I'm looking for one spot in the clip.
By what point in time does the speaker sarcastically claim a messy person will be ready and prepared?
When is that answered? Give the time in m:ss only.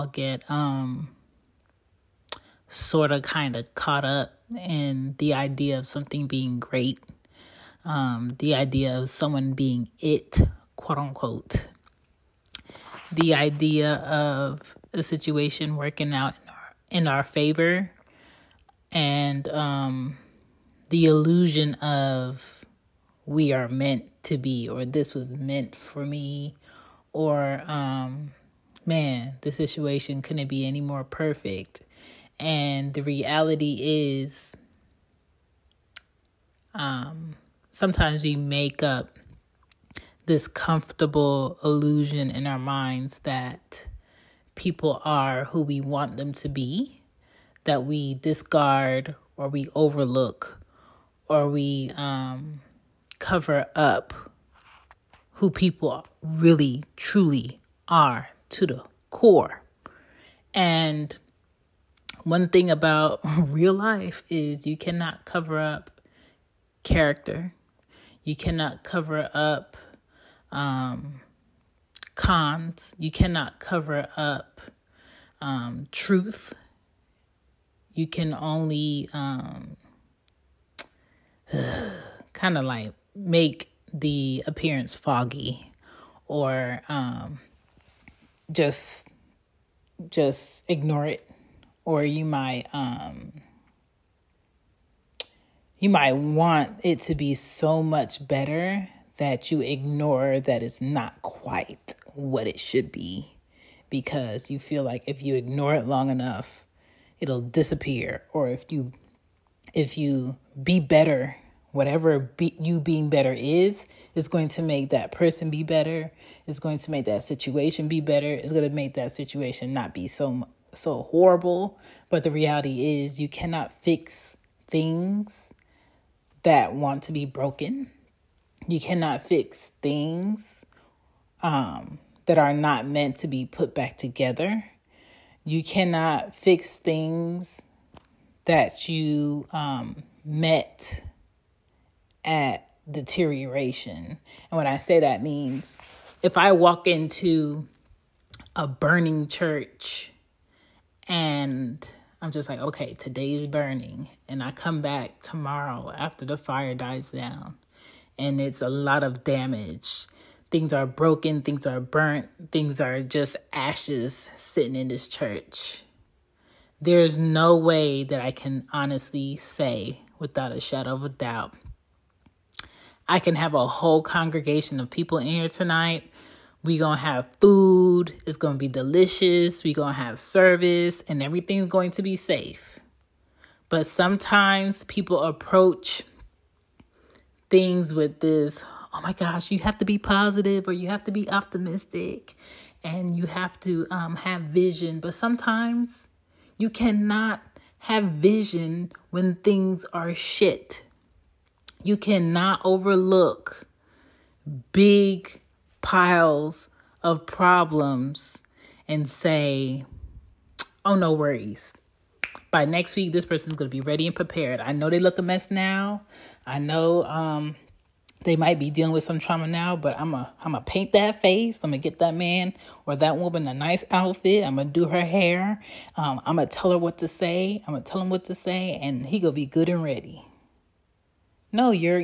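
3:32.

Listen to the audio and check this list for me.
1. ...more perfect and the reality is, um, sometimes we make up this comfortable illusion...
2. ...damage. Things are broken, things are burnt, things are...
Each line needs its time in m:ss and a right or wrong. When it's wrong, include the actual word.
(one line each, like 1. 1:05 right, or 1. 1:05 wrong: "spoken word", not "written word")
1. 0:30 right
2. 2:39 right.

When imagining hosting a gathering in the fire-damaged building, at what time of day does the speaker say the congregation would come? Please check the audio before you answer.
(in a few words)
tonight.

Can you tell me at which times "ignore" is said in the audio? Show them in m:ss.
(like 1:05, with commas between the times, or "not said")
1:30, 1:39, 1:45.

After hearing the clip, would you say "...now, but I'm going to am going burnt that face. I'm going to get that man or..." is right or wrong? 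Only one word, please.
wrong.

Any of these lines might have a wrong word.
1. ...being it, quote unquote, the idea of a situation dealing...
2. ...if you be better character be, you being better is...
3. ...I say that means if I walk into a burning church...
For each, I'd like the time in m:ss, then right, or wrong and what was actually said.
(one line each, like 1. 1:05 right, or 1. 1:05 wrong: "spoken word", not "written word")
1. 0:09 wrong: "working", not "dealing"
2. 1:49 wrong: "whatever", not "character"
3. 2:24 right.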